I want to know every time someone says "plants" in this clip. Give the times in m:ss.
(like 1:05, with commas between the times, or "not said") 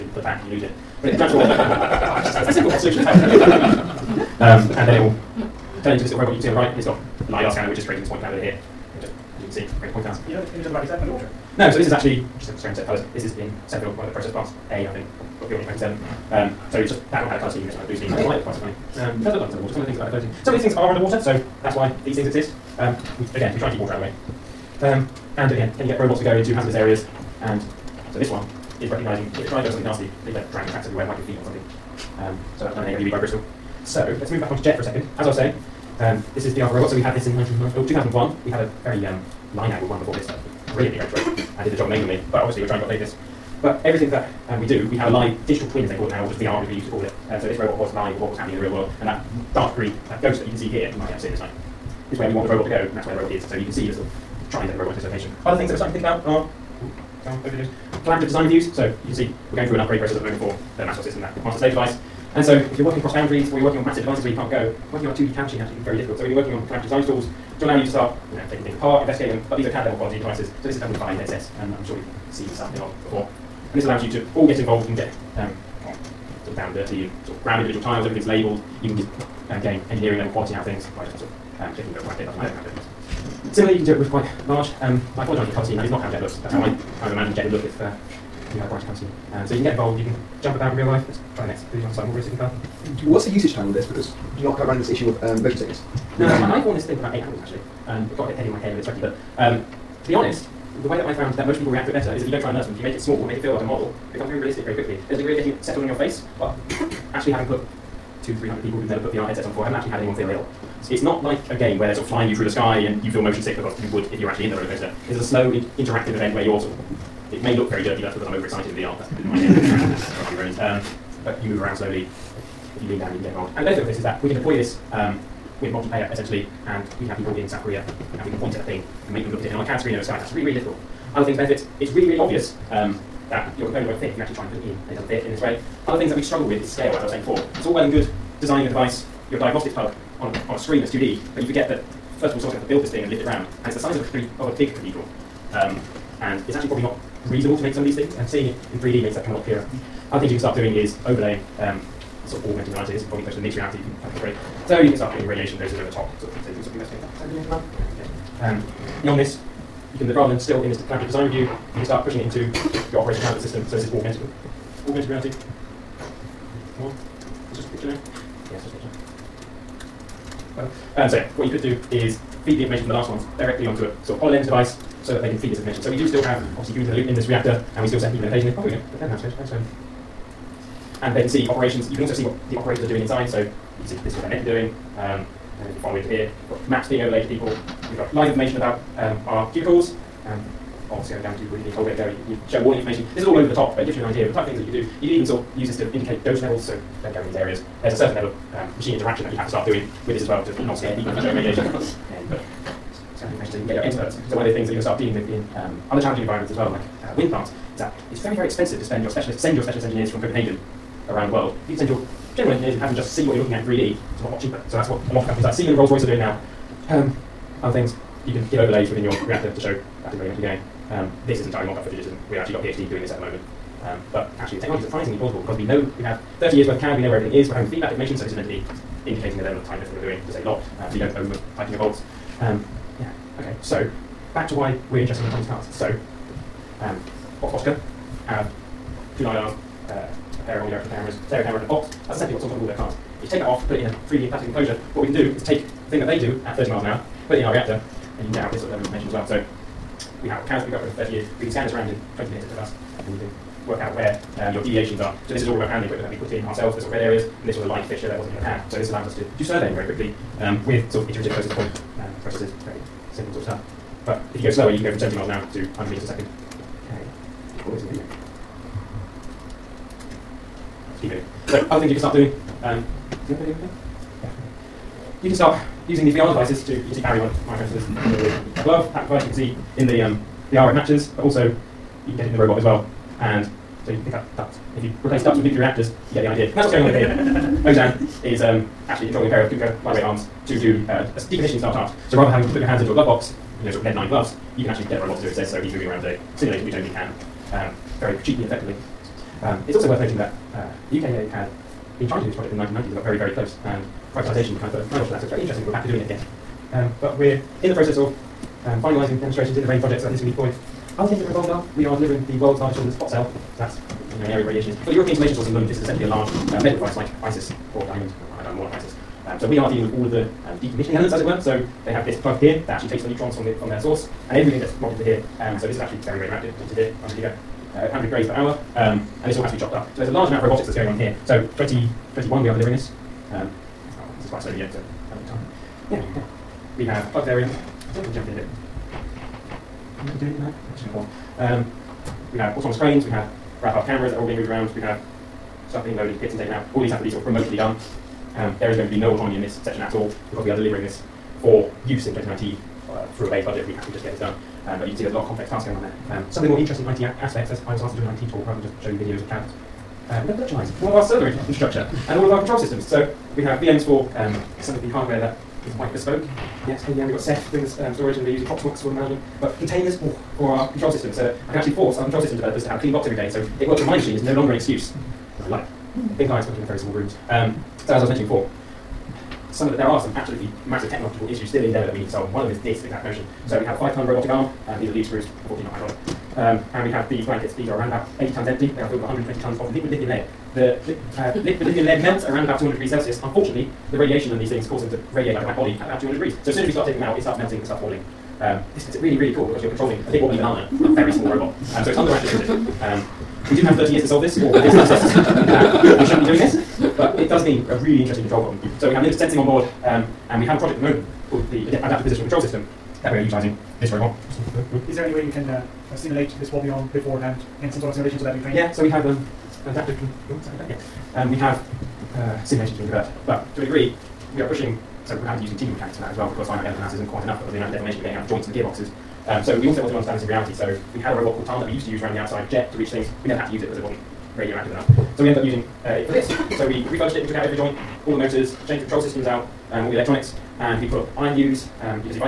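0:14, 3:27.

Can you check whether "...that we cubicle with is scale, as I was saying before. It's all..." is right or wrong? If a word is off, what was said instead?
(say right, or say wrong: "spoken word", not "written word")
wrong: "struggle", not "cubicle".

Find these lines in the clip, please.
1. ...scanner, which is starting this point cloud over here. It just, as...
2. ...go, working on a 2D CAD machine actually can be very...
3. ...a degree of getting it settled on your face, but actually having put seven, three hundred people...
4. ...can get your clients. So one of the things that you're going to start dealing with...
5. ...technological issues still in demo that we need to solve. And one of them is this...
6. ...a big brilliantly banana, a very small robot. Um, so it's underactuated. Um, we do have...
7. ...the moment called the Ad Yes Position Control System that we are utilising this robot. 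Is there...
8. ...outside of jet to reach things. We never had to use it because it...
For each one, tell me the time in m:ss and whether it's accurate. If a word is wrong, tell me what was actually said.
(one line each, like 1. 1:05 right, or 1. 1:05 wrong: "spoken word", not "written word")
1. 0:07 wrong: "creating", not "starting"
2. 1:04 right
3. 1:45 wrong: "two", not "seven"
4. 3:23 wrong: "experts", not "clients"
5. 6:20 right
6. 6:40 wrong: "wobbly", not "brilliantly"
7. 6:50 wrong: "Adaptive", not "Yes"
8. 7:12 right.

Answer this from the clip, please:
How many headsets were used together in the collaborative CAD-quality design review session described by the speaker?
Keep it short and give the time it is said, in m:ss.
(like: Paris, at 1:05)
5, at 1:10.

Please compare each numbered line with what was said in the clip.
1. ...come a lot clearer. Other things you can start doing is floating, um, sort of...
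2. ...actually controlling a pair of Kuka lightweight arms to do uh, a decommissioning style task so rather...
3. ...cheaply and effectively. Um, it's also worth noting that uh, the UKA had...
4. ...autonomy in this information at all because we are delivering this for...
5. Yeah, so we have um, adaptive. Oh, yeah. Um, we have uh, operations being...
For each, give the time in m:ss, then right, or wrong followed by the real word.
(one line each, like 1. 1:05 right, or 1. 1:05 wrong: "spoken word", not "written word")
1. 2:29 wrong: "overlaying", not "floating"
2. 4:48 right
3. 4:58 right
4. 5:49 wrong: "section", not "information"
5. 6:58 wrong: "simulations", not "operations".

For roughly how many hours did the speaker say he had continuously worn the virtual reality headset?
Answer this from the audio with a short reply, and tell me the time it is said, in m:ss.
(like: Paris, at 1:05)
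8 hours, at 1:37.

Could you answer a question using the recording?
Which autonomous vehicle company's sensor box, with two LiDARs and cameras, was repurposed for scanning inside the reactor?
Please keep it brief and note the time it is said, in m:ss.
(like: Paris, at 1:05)
Oxbotica, at 3:57.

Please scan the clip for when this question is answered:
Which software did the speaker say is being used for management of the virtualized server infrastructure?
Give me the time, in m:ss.
6:08.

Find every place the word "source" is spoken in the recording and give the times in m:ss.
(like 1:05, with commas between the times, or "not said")
5:15, 5:23.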